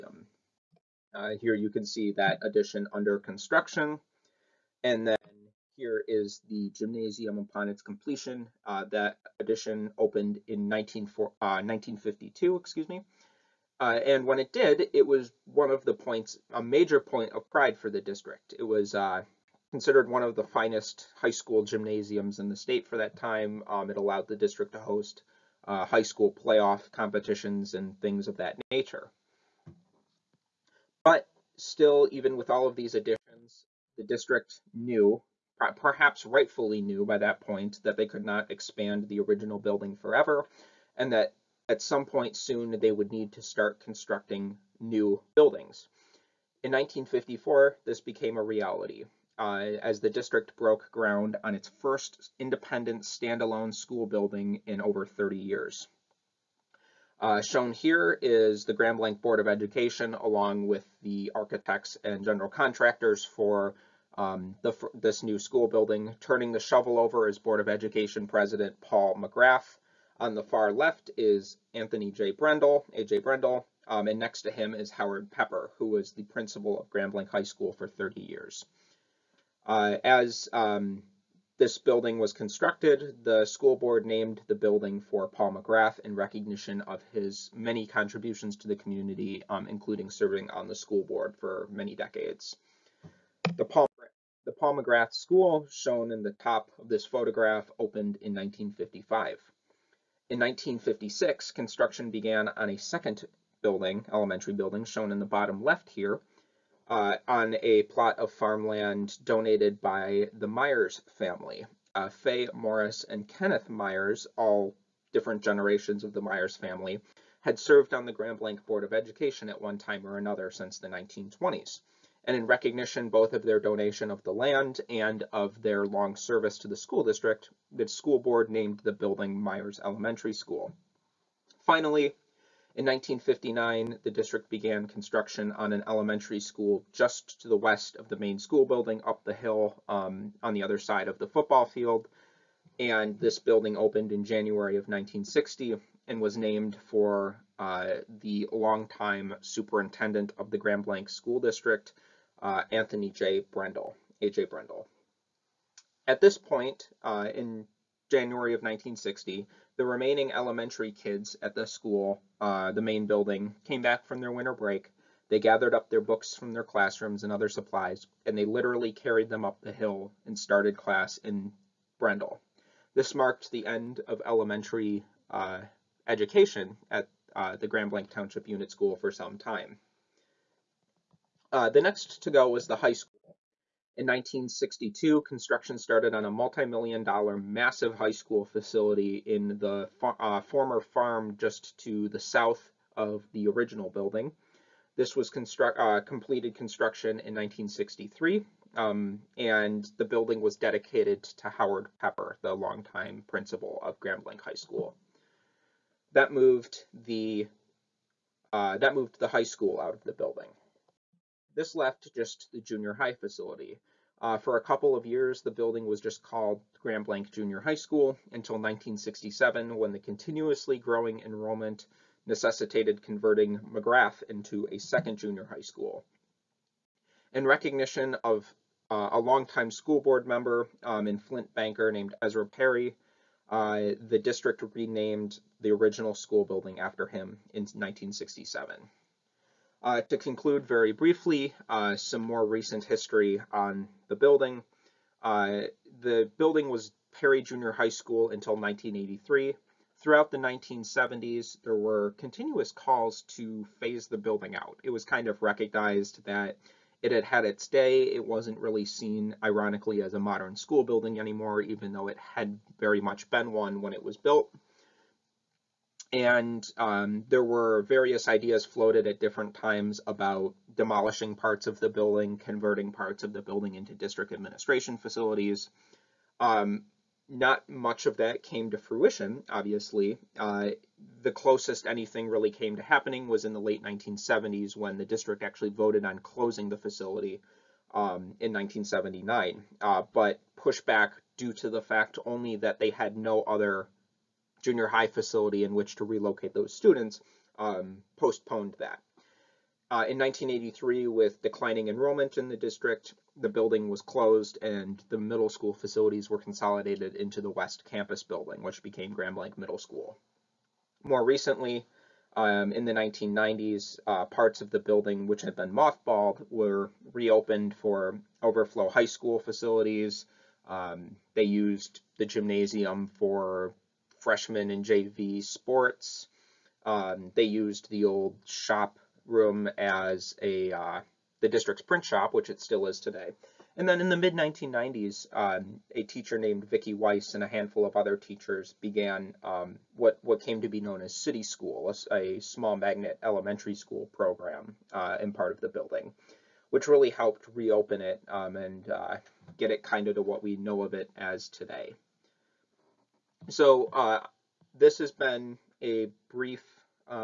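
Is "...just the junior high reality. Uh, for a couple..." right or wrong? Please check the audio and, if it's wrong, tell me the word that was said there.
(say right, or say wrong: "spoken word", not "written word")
wrong: "facility", not "reality".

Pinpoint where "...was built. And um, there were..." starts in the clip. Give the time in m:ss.
4:24.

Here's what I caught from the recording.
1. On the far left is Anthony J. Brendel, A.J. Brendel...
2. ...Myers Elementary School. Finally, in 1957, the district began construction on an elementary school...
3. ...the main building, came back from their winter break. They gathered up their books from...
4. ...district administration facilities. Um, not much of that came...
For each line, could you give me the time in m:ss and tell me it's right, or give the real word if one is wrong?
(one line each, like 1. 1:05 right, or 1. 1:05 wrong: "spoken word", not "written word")
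1. 1:10 right
2. 2:09 wrong: "1959", not "1957"
3. 2:42 right
4. 4:33 right.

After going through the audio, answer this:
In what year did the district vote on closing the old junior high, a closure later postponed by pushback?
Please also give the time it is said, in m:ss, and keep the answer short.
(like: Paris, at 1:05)
1979, at 4:48.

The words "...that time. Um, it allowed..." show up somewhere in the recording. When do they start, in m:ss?
0:22.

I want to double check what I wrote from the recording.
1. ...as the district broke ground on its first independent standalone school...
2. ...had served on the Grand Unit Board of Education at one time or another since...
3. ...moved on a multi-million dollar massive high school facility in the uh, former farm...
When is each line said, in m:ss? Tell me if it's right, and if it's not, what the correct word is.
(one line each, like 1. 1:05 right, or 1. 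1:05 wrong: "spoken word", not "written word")
1. 0:49 right
2. 1:57 wrong: "Blanc", not "Unit"
3. 3:05 wrong: "started", not "moved".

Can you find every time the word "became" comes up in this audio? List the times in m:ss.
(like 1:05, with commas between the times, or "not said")
0:48, 5:08.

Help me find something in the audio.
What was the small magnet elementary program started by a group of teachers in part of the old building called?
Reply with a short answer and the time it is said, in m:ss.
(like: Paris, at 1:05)
City School, at 5:41.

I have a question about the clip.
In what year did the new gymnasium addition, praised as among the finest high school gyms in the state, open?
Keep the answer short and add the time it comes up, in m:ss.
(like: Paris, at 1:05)
1952, at 0:11.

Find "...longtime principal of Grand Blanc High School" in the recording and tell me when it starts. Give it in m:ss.
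3:22.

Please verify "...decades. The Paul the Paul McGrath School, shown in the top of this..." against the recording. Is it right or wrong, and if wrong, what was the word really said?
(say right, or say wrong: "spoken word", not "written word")
right.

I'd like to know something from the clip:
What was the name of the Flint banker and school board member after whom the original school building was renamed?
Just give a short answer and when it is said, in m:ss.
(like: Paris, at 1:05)
Ezra Perry, at 3:52.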